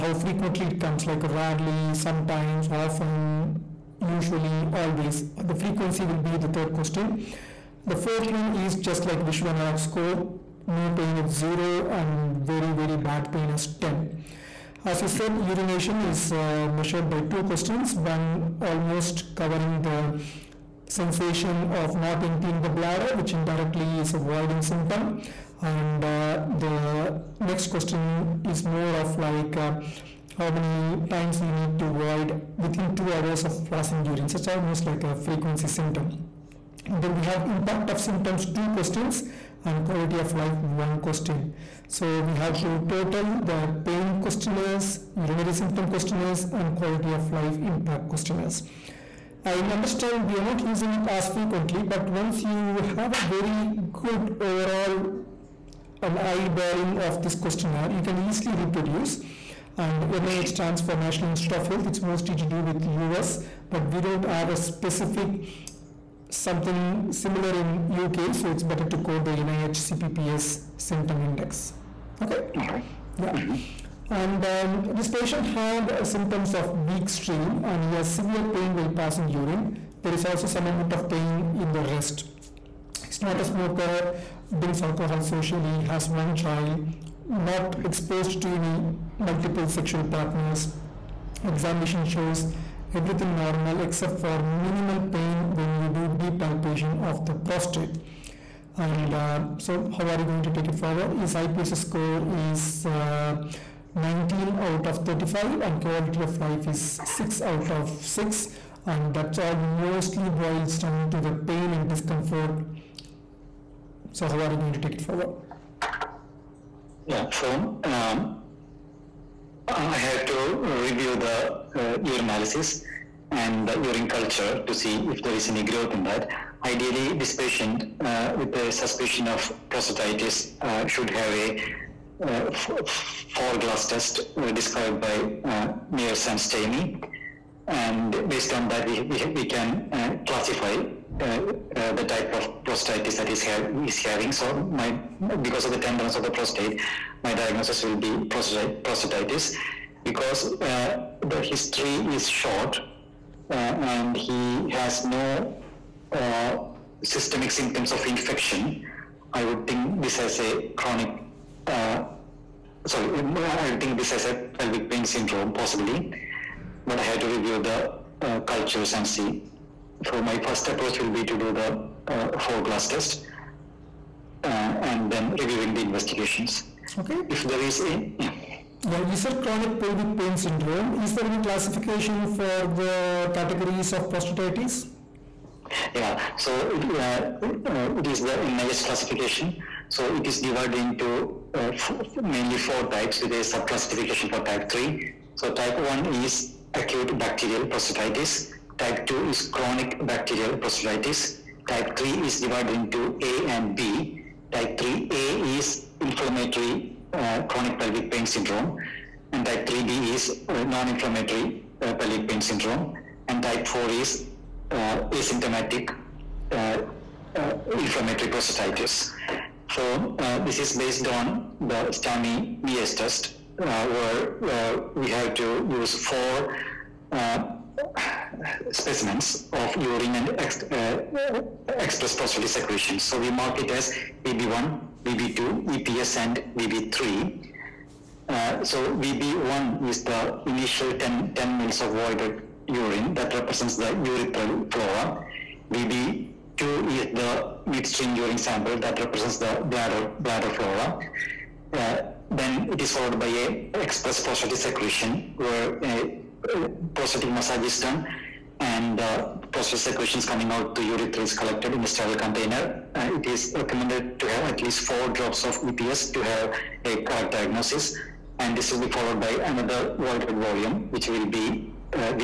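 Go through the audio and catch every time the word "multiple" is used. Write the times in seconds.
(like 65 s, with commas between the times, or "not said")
89 s.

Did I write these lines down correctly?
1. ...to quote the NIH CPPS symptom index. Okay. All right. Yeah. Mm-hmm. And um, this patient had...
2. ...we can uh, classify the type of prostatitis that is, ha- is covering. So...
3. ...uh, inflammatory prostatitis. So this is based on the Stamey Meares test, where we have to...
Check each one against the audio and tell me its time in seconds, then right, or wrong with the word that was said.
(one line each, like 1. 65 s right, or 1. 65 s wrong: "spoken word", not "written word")
1. 68 s right
2. 139 s wrong: "having", not "covering"
3. 217 s right.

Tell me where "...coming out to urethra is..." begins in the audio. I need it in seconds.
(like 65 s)
260 s.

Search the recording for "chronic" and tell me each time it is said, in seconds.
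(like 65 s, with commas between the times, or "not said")
160 s, 179 s, 199 s, 207 s.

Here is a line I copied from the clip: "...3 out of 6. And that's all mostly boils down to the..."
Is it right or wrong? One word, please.
wrong.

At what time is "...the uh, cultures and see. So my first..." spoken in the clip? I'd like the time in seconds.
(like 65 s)
167 s.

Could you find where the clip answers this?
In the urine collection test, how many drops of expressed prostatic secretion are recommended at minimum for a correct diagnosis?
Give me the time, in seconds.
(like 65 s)
264 s.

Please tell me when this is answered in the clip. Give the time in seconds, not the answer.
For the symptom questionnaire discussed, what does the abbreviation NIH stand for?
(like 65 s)
60 s.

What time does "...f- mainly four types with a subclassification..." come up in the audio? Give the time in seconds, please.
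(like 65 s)
191 s.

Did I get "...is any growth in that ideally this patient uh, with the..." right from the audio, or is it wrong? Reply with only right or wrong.
right.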